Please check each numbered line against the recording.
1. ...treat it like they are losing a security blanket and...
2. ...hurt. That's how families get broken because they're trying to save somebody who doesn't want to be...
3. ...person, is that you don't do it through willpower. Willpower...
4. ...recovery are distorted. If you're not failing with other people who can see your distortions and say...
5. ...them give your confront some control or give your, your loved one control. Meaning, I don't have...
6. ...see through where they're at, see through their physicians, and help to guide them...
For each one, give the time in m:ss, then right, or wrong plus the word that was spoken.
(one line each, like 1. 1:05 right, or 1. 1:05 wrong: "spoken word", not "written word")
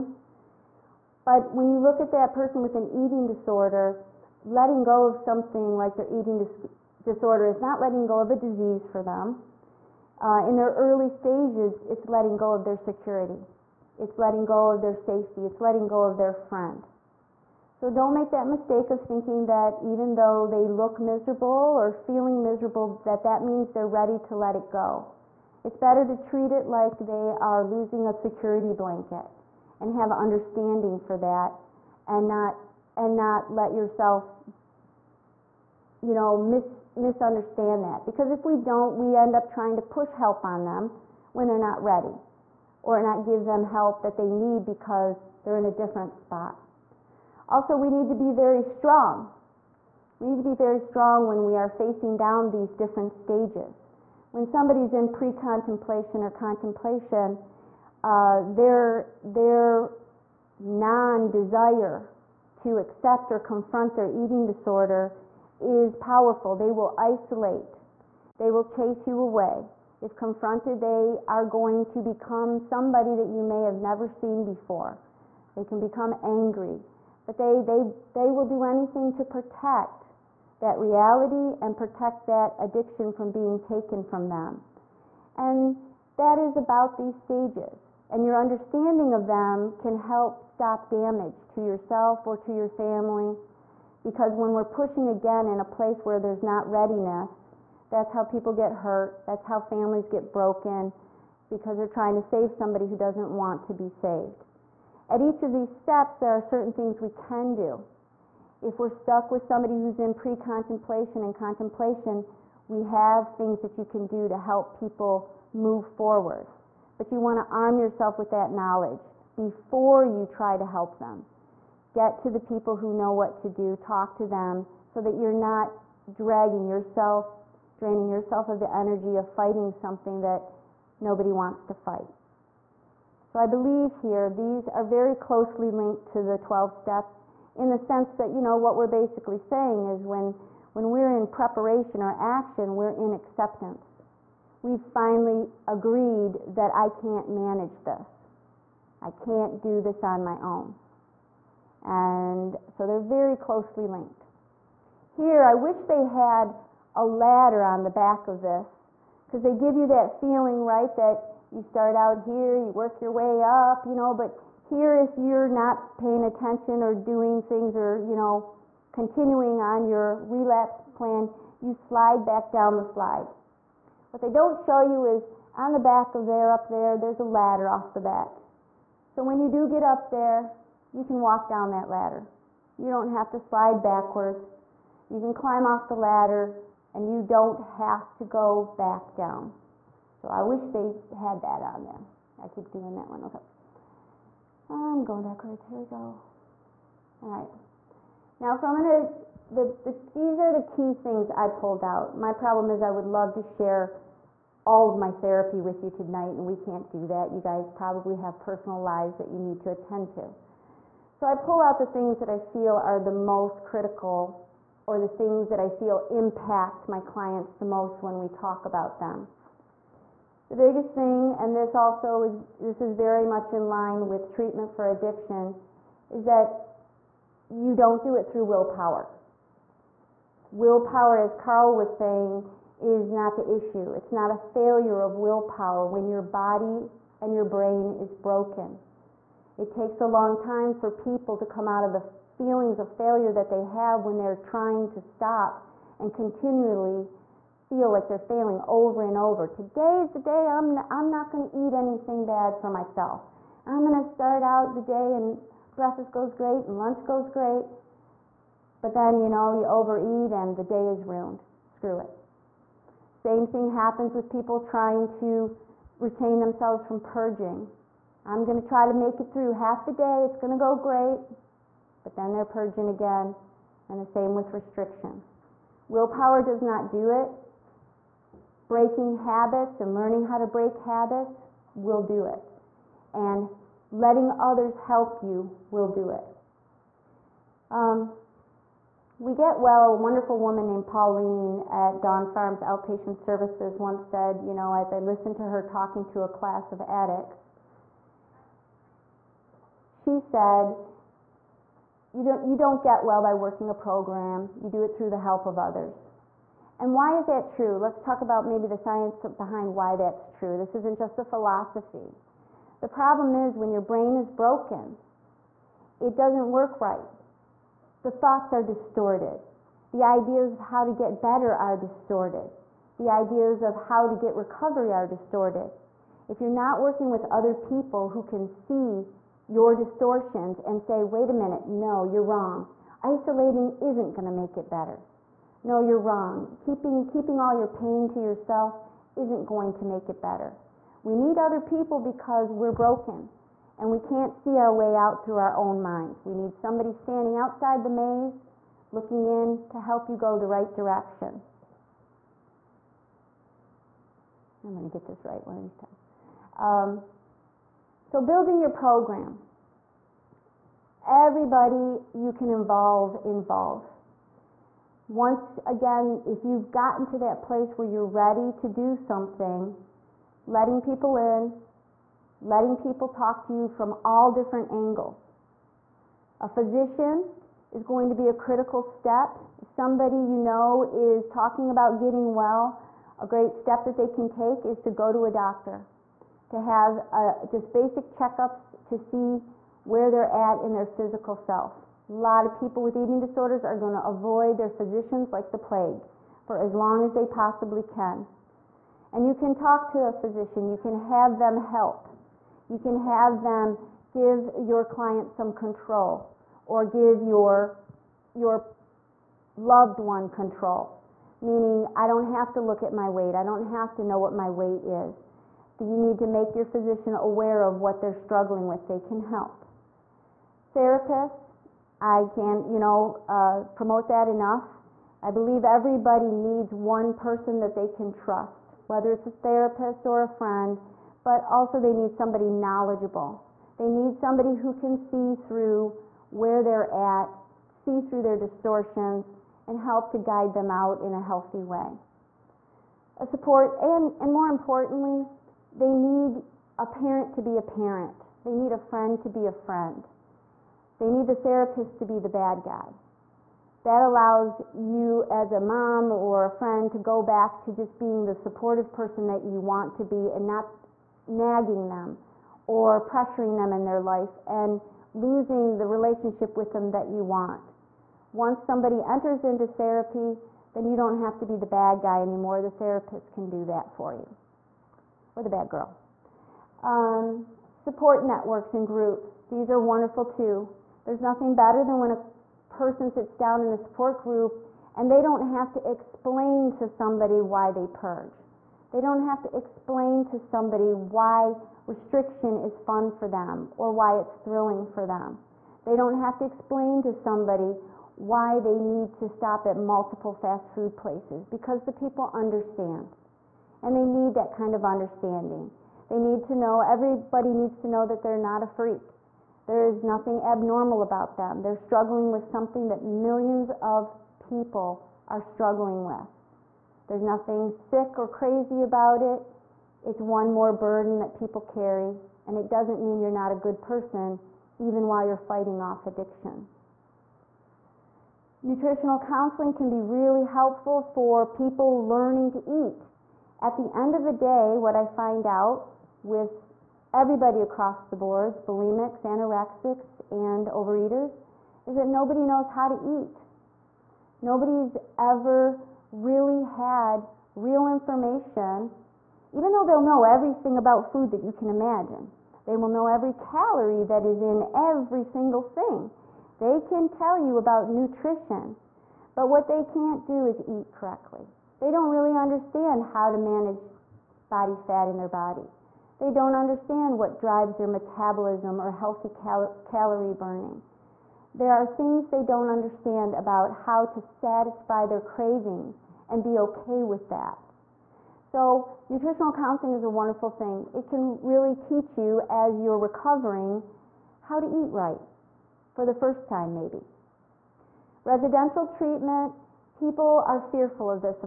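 1. 0:26 right
2. 1:38 right
3. 3:44 wrong: "addiction", not "person"
4. 5:24 wrong: "working", not "failing"
5. 6:43 wrong: "client", not "confront"
6. 7:15 wrong: "distortions", not "physicians".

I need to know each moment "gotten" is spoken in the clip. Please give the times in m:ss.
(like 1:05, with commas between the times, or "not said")
6:06.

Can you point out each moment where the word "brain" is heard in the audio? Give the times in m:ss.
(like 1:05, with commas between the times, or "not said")
3:57, 5:13.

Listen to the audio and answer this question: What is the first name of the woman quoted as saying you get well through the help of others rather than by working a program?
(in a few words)
Pauline.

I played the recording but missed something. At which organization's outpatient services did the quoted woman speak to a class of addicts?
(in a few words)
Dawn Farms.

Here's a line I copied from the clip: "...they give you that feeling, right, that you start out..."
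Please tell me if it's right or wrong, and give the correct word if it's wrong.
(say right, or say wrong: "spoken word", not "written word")
right.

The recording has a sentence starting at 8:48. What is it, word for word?
Nutritional counseling can be really helpful for people learning to eat.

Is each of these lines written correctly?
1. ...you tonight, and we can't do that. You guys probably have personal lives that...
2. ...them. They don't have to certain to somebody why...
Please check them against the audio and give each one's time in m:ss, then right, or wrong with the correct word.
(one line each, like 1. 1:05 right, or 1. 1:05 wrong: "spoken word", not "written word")
1. 3:25 right
2. 8:15 wrong: "explain", not "certain".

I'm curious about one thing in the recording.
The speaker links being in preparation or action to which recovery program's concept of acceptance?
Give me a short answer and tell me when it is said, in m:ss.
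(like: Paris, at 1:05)
the 12 steps, at 2:16.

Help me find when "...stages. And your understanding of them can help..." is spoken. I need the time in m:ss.
1:27.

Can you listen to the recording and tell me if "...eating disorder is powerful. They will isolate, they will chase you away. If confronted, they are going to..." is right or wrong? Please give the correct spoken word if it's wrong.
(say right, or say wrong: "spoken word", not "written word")
right.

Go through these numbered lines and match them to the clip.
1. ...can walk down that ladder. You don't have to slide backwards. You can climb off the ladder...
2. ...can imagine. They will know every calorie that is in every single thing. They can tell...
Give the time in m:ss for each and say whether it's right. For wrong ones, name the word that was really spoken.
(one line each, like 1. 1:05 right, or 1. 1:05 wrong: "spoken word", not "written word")
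1. 3:01 right
2. 9:11 right.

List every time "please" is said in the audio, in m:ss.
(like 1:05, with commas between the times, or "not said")
not said.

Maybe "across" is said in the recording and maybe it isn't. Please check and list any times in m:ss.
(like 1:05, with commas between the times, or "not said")
8:57.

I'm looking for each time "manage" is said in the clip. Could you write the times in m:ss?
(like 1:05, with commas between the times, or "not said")
2:27, 9:23.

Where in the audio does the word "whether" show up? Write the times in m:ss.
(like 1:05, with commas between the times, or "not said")
7:08.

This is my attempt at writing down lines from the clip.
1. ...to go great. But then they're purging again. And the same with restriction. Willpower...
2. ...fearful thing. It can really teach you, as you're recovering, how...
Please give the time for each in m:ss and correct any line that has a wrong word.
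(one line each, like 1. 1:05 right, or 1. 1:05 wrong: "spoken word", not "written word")
1. 4:30 right
2. 9:40 wrong: "wonderful", not "fearful".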